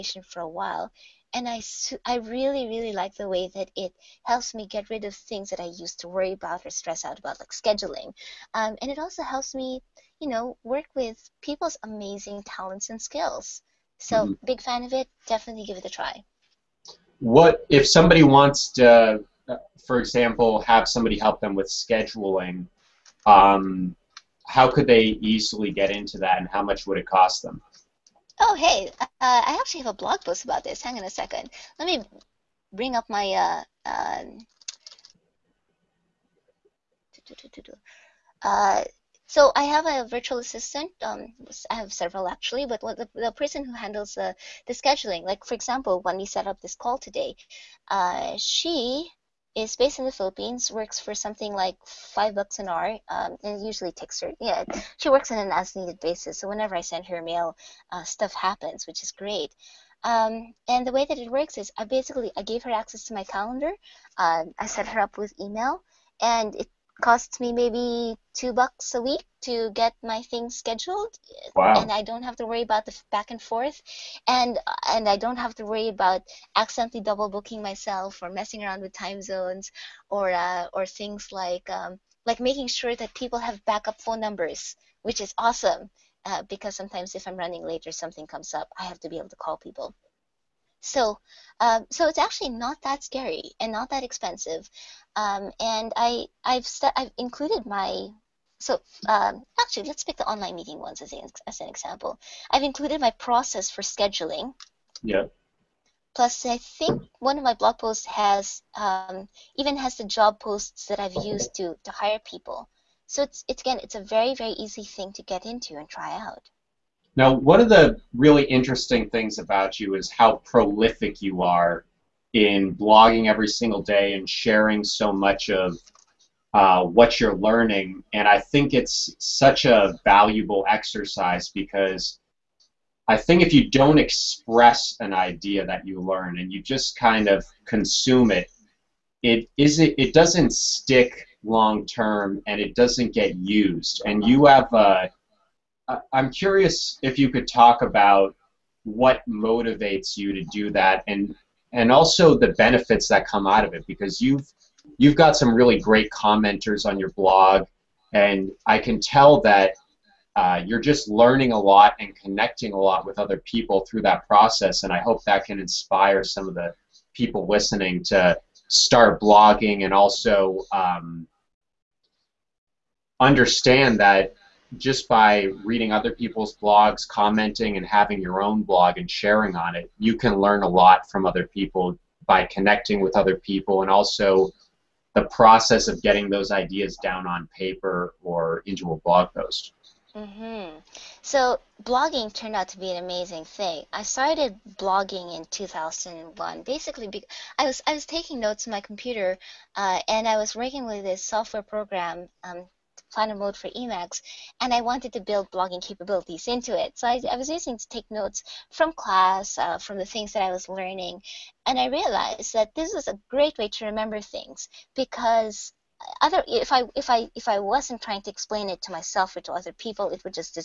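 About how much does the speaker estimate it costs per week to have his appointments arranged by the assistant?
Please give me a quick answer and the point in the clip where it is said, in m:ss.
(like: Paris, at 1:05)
$2 a week, at 1:08.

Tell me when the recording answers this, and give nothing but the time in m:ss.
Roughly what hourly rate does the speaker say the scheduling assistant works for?
0:51.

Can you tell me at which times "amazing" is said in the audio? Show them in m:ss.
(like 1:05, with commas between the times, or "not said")
0:11, 3:13.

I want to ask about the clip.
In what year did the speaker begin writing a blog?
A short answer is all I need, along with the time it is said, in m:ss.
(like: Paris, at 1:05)
2001, at 3:15.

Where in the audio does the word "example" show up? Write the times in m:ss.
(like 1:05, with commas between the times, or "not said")
0:20, 0:45, 1:41.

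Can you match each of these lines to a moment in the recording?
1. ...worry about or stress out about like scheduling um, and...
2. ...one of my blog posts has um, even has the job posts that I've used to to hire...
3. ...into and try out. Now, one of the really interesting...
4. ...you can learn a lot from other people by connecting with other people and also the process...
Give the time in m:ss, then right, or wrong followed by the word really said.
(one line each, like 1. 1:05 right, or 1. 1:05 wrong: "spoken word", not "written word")
1. 0:06 right
2. 1:47 right
3. 1:55 right
4. 2:59 right.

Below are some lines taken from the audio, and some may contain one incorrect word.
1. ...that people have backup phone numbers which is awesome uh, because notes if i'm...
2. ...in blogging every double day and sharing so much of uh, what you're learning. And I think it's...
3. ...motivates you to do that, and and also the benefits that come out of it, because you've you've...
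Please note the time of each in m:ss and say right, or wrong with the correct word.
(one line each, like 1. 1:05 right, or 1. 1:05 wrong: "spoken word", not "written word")
1. 1:22 wrong: "sometimes", not "notes"
2. 2:02 wrong: "single", not "double"
3. 2:29 right.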